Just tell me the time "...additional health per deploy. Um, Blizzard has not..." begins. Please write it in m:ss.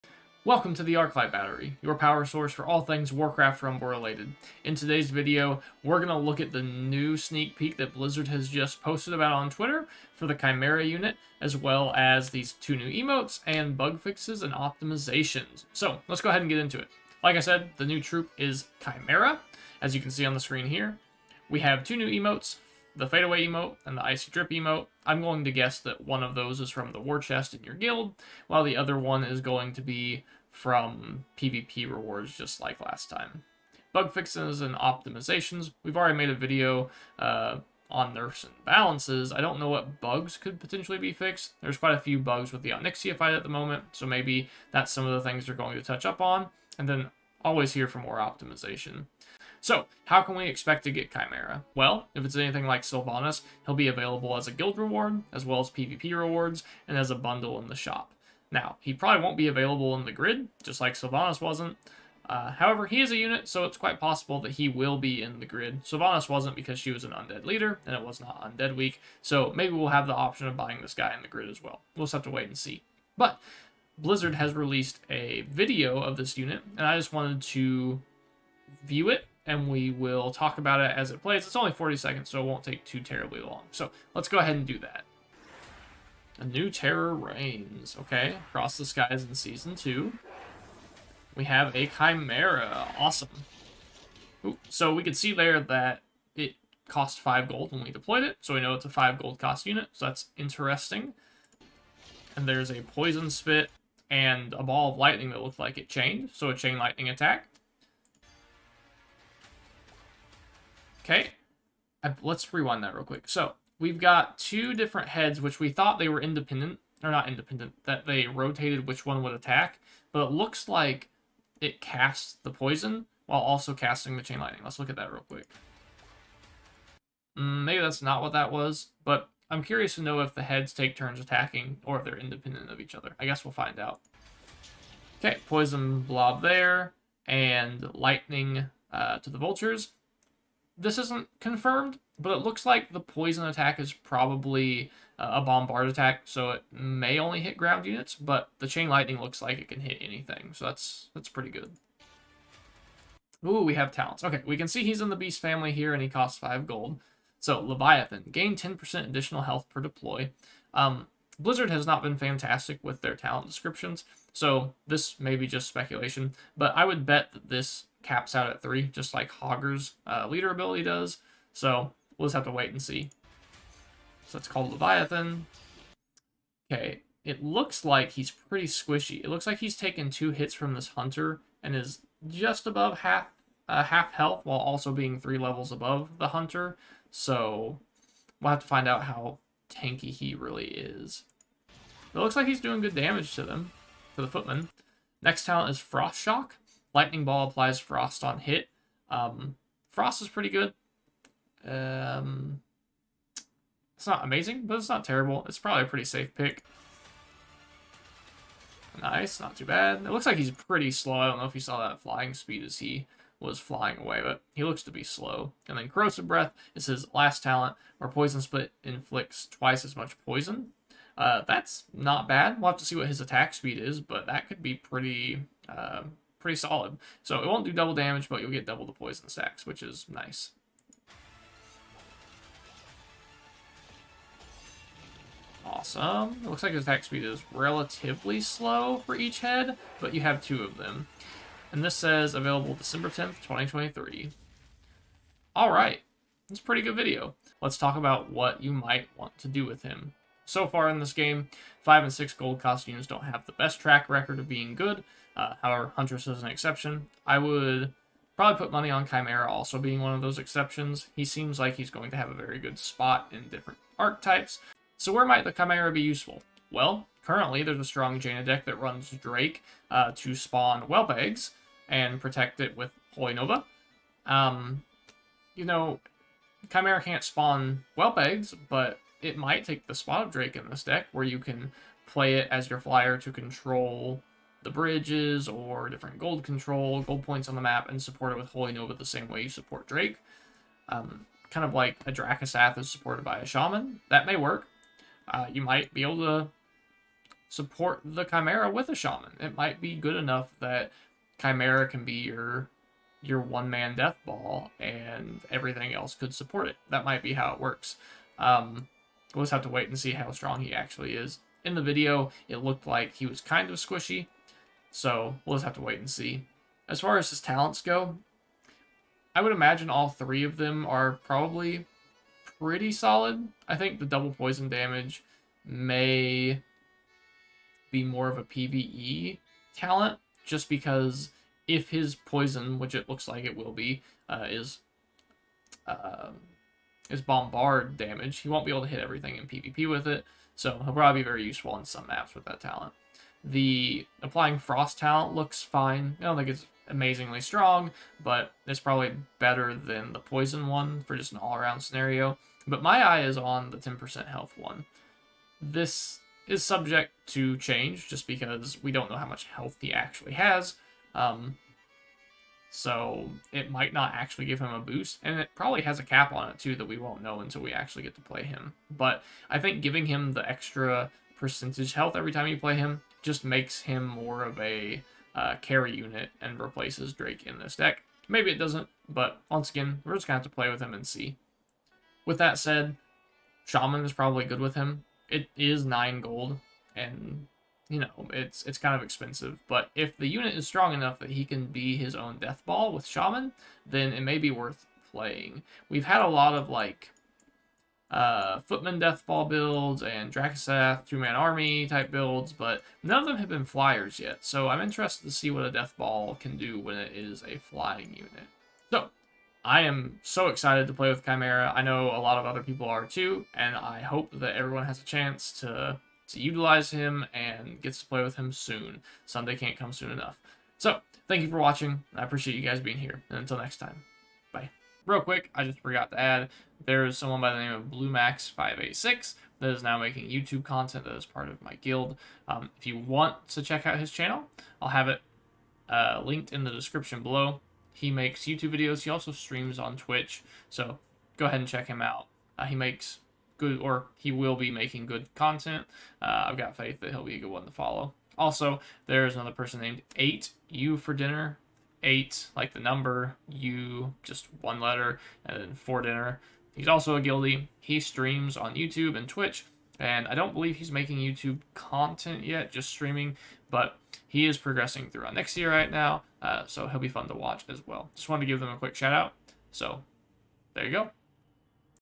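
2:39.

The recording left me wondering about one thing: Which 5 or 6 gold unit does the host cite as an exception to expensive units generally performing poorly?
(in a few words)
Huntress.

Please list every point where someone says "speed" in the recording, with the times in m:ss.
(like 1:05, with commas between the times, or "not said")
3:32, 3:43, 3:57.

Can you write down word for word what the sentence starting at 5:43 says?
The applying frost talent looks fine.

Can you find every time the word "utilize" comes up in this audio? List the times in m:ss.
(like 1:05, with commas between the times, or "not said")
6:56.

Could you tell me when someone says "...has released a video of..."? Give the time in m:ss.
1:14.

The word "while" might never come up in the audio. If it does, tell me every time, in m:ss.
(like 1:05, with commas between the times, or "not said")
0:28, 2:03, 3:04.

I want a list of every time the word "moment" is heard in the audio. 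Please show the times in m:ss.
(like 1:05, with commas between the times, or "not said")
0:43.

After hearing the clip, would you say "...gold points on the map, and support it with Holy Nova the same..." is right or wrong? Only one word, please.
right.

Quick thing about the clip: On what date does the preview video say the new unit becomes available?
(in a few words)
December 10th, 2023.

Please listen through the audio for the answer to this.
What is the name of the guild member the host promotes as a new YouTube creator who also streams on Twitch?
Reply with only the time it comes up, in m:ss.
7:07.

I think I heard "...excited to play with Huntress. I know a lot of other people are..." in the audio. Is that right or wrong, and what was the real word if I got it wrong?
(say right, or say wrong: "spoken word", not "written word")
wrong: "Chimaera", not "Huntress".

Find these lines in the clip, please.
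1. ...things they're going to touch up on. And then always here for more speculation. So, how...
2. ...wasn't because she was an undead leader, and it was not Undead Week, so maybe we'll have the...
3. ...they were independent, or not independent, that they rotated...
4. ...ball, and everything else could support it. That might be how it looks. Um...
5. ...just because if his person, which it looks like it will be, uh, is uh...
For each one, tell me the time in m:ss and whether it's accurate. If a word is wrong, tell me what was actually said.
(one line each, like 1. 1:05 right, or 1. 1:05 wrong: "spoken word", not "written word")
1. 0:45 wrong: "optimization", not "speculation"
2. 1:06 right
3. 1:55 right
4. 5:04 wrong: "works", not "looks"
5. 5:30 wrong: "poison", not "person".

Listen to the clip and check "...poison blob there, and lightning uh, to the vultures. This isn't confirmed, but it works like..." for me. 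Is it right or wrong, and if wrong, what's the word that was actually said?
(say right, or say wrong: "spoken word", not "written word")
wrong: "looks", not "works".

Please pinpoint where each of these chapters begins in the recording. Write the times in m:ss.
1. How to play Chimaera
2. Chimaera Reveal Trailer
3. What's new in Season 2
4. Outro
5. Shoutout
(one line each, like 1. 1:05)
1. 4:07
2. 1:25
3. 0:16
4. 6:47
5. 7:05.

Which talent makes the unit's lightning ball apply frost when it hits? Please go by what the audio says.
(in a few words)
Frost Shock.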